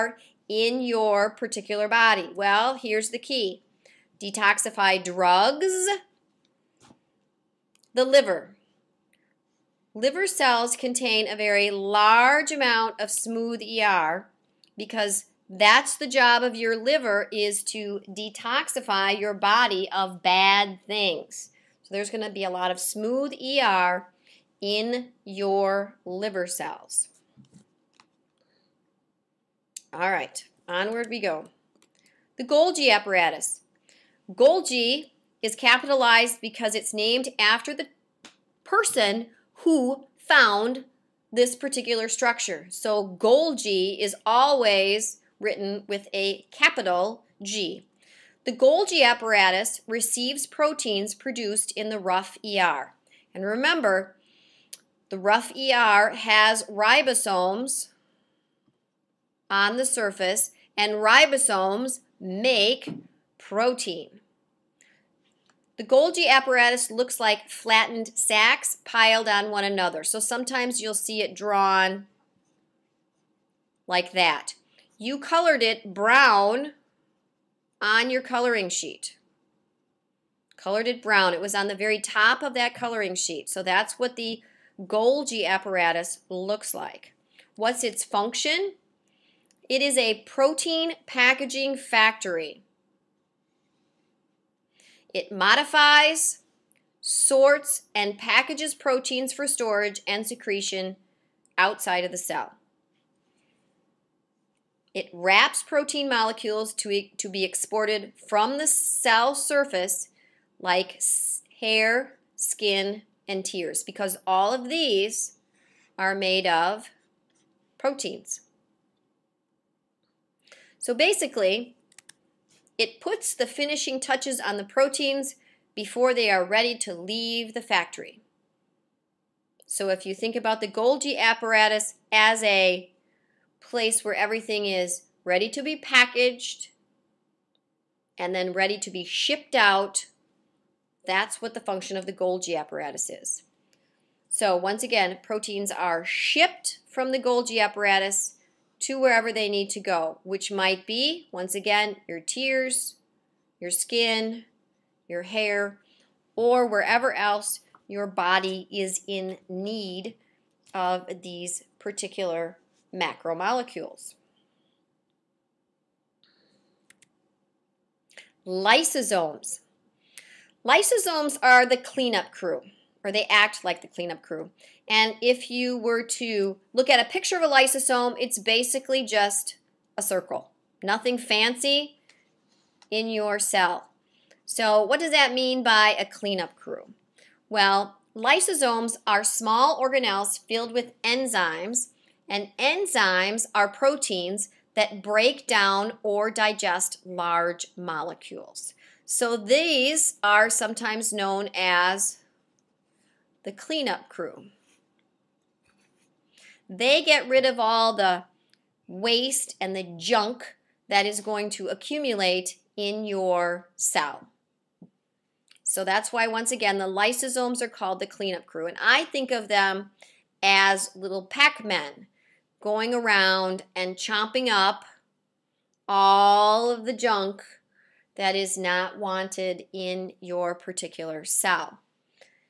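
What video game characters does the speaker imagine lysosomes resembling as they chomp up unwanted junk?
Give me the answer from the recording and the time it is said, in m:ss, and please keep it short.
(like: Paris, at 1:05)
Pac Men, at 3:41.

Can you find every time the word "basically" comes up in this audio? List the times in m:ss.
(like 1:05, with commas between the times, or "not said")
2:00, 2:58.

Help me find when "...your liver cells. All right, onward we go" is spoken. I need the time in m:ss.
0:25.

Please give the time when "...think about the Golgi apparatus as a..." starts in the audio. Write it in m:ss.
2:10.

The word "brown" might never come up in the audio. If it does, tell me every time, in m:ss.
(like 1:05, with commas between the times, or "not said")
1:15, 1:21.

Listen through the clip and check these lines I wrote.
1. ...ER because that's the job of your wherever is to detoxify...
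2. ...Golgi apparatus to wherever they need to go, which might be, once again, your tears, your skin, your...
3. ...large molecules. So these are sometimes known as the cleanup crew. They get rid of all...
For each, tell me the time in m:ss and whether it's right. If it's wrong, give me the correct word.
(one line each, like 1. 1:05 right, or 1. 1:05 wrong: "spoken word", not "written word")
1. 0:13 wrong: "liver", not "wherever"
2. 2:27 right
3. 3:17 right.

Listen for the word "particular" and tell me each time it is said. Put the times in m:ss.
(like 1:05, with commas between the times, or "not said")
0:01, 0:41, 2:41, 3:50.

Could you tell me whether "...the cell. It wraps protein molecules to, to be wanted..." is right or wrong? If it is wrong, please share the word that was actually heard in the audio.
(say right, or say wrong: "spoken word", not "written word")
wrong: "exported", not "wanted".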